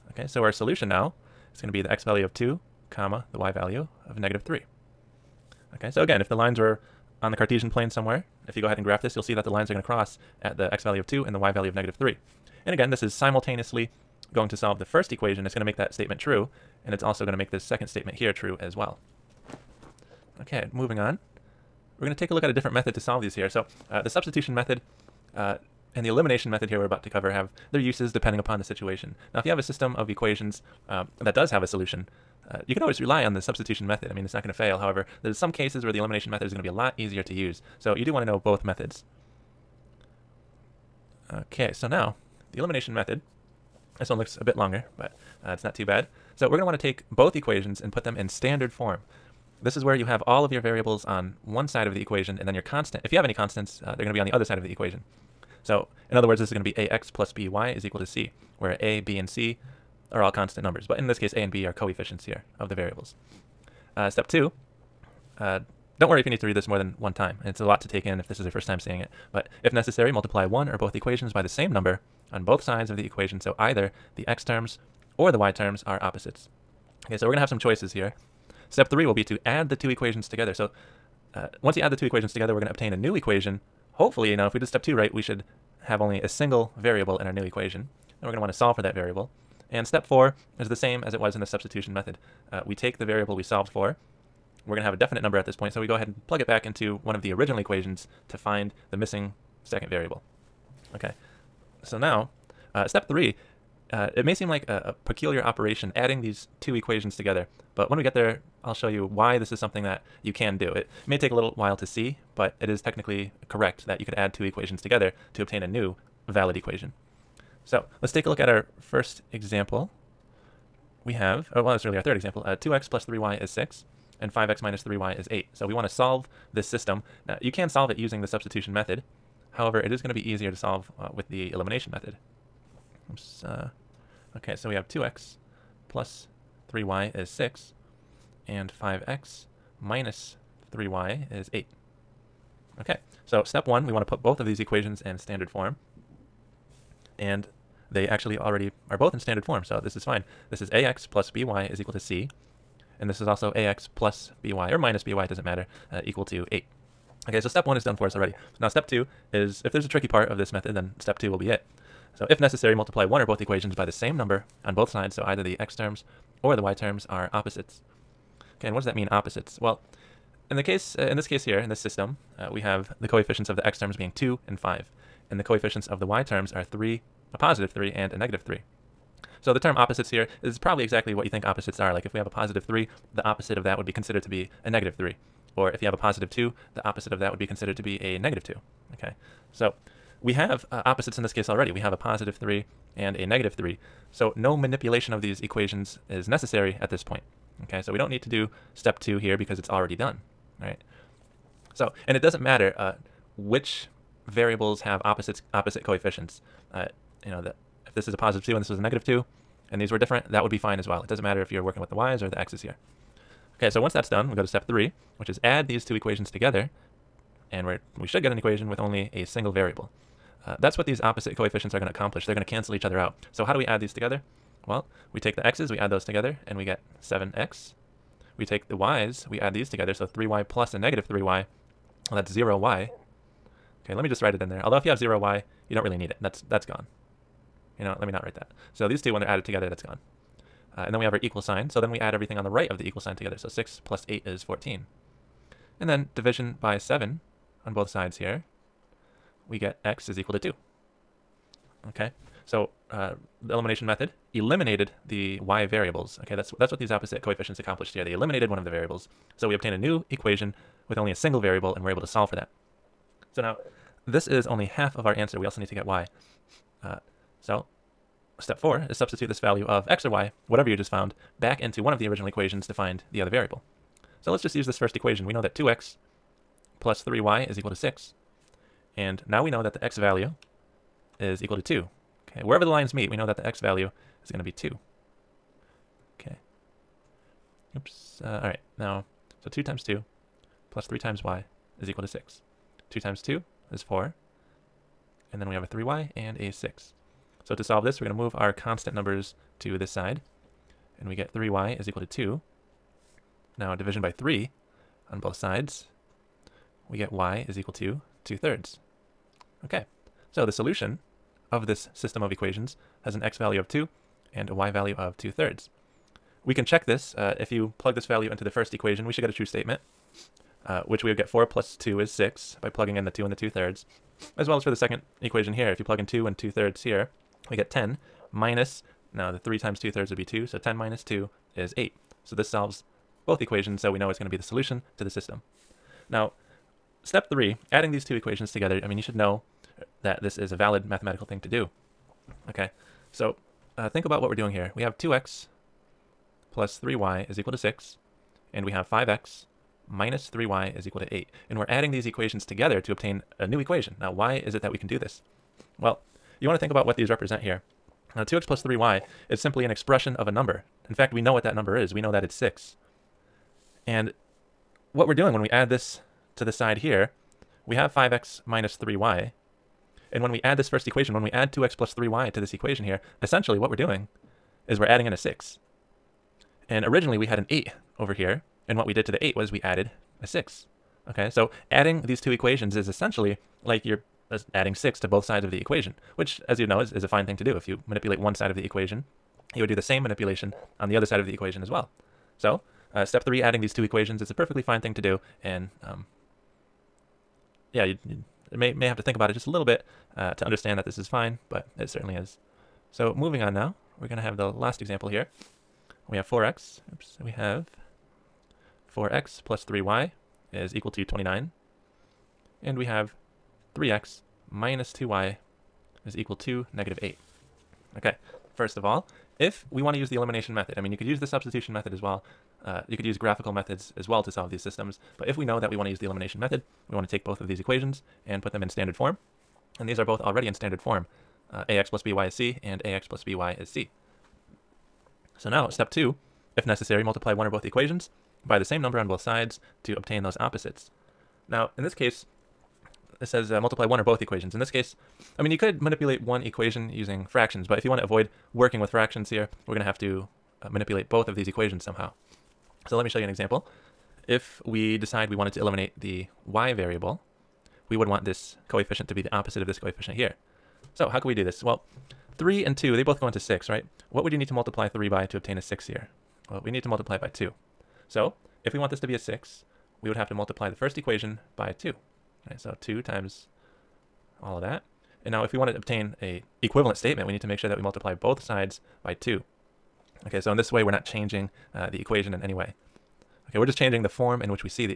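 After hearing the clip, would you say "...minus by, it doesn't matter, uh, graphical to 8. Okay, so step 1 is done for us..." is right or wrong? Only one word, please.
wrong.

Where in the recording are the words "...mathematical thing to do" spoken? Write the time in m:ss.
5:40.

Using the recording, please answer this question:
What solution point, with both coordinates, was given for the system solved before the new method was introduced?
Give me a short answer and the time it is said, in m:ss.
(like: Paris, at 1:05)
(2, -3), at 0:01.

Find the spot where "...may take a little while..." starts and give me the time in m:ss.
1:51.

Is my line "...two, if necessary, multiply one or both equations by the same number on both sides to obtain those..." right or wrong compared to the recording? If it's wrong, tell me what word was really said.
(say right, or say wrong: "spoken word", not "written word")
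right.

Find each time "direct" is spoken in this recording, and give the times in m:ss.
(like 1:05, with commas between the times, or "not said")
not said.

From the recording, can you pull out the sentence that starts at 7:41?
Well, 3 and 2, they both go into 6, right?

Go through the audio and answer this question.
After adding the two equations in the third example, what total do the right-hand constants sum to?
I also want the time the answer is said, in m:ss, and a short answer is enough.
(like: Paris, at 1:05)
14, at 4:03.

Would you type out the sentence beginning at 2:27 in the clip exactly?
And they actually already are both in standard form, so this is fine.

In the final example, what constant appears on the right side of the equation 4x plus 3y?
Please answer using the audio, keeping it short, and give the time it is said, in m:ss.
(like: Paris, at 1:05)
29, at 6:51.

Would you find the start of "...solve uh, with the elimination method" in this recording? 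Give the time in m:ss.
2:10.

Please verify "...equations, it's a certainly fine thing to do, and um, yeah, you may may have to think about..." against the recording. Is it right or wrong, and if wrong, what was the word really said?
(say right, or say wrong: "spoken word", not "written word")
wrong: "perfectly", not "certainly".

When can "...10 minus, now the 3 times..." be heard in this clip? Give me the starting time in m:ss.
5:27.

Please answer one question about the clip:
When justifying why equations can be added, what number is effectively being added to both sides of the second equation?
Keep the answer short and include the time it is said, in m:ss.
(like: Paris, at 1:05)
6, at 6:24.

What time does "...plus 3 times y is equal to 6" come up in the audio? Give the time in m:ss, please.
4:50.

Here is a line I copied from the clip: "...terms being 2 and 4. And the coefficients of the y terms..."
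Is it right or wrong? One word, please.
wrong.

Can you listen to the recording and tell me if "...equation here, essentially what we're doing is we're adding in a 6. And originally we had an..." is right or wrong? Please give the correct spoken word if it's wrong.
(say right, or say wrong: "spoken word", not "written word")
right.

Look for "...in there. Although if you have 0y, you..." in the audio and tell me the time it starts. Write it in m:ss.
3:54.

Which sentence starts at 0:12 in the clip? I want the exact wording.
And again, this is simultaneously going to solve the first equation.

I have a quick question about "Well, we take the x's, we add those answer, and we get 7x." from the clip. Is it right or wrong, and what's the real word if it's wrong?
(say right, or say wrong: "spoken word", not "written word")
wrong: "together", not "answer".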